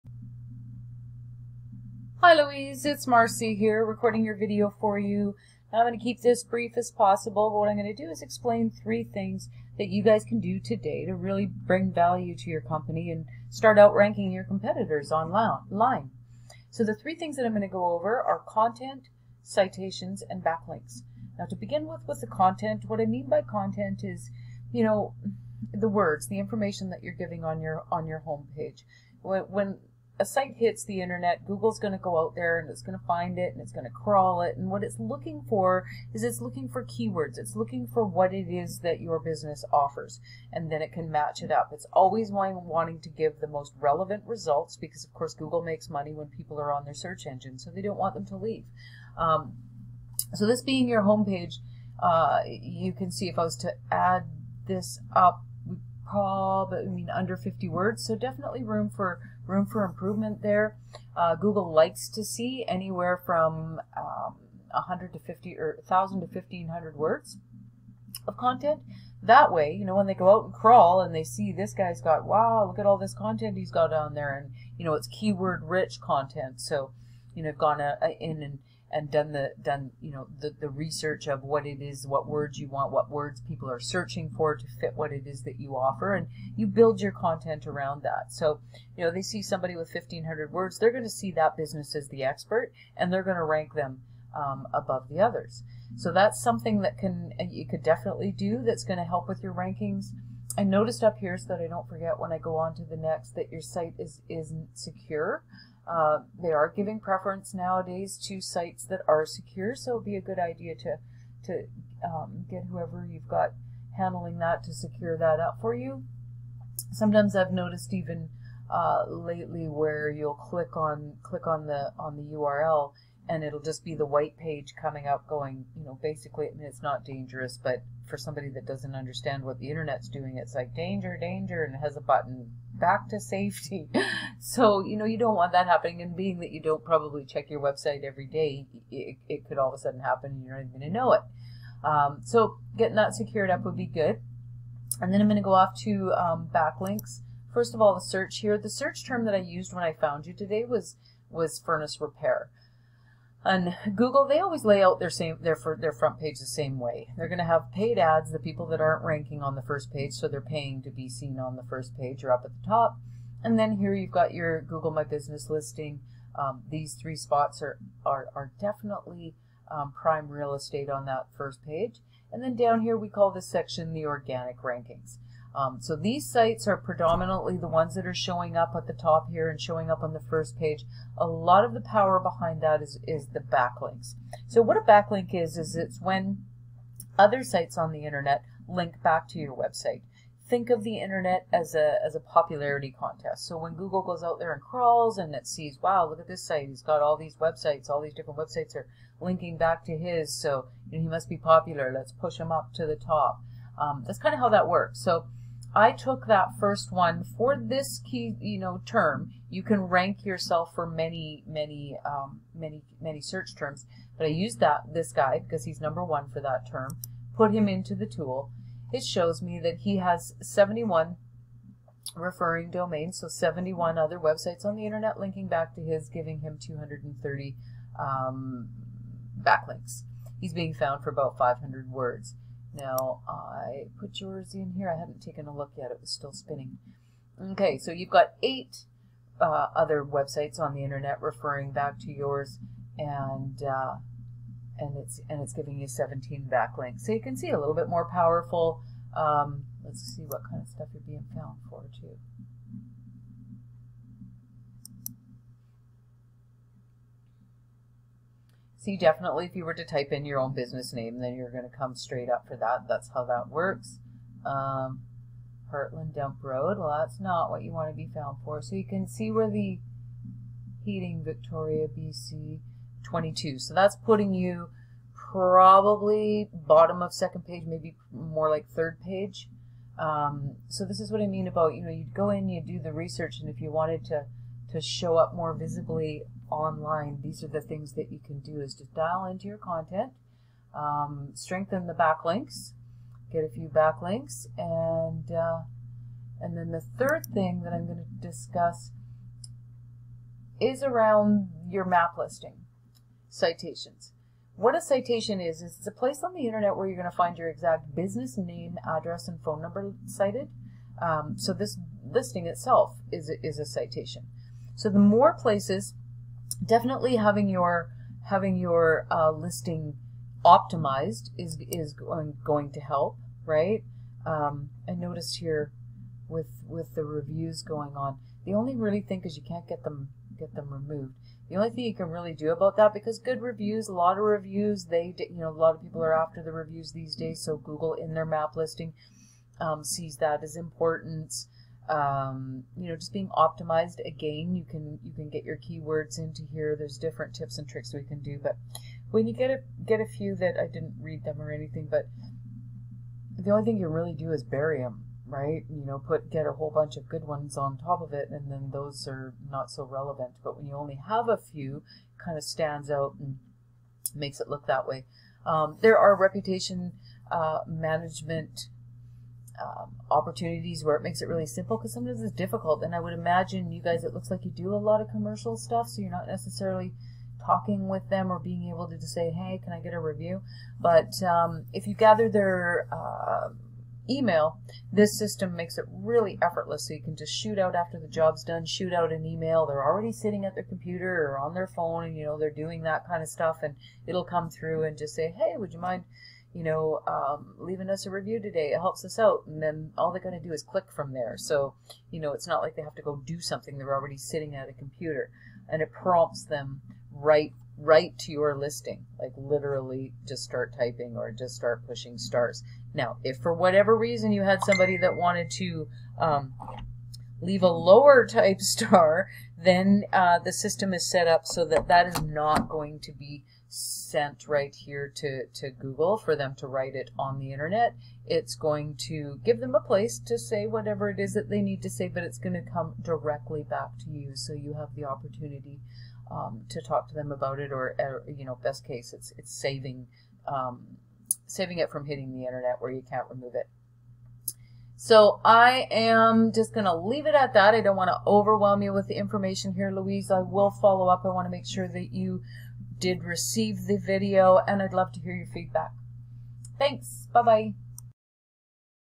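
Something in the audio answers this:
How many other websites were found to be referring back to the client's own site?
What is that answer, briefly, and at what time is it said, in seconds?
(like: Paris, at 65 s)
8, at 238 s.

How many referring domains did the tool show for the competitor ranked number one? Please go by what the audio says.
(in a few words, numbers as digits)
71.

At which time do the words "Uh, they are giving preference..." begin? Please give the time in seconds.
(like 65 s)
105 s.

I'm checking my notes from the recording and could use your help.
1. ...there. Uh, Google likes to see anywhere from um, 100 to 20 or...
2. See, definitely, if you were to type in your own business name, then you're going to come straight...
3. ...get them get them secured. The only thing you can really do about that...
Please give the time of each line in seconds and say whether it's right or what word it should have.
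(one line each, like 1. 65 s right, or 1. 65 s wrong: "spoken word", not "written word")
1. 60 s wrong: "50", not "20"
2. 258 s right
3. 329 s wrong: "removed", not "secured".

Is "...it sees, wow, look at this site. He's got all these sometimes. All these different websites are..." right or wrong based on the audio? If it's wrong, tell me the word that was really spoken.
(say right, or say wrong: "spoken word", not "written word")
wrong: "websites", not "sometimes".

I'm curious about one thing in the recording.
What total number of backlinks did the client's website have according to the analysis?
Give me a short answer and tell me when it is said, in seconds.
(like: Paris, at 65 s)
17, at 245 s.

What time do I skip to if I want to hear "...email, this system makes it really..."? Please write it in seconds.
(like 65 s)
384 s.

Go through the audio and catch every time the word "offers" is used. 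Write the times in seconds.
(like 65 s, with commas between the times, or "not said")
39 s, 85 s.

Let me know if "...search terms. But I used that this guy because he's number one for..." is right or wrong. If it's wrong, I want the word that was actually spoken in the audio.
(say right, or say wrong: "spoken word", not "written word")
right.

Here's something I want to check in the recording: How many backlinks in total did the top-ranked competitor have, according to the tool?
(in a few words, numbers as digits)
230.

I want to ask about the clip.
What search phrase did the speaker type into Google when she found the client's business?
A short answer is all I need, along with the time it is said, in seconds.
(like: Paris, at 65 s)
furnace repair, at 151 s.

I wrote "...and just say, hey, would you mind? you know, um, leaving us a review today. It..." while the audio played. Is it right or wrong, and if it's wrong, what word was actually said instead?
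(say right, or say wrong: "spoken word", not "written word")
right.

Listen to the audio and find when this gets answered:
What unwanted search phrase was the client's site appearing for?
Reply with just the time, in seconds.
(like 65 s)
265 s.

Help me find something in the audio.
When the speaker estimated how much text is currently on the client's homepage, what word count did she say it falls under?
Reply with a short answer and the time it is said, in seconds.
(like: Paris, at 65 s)
50 words, at 57 s.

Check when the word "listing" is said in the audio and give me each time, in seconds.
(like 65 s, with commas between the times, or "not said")
165 s, 302 s, 312 s, 319 s, 338 s, 408 s.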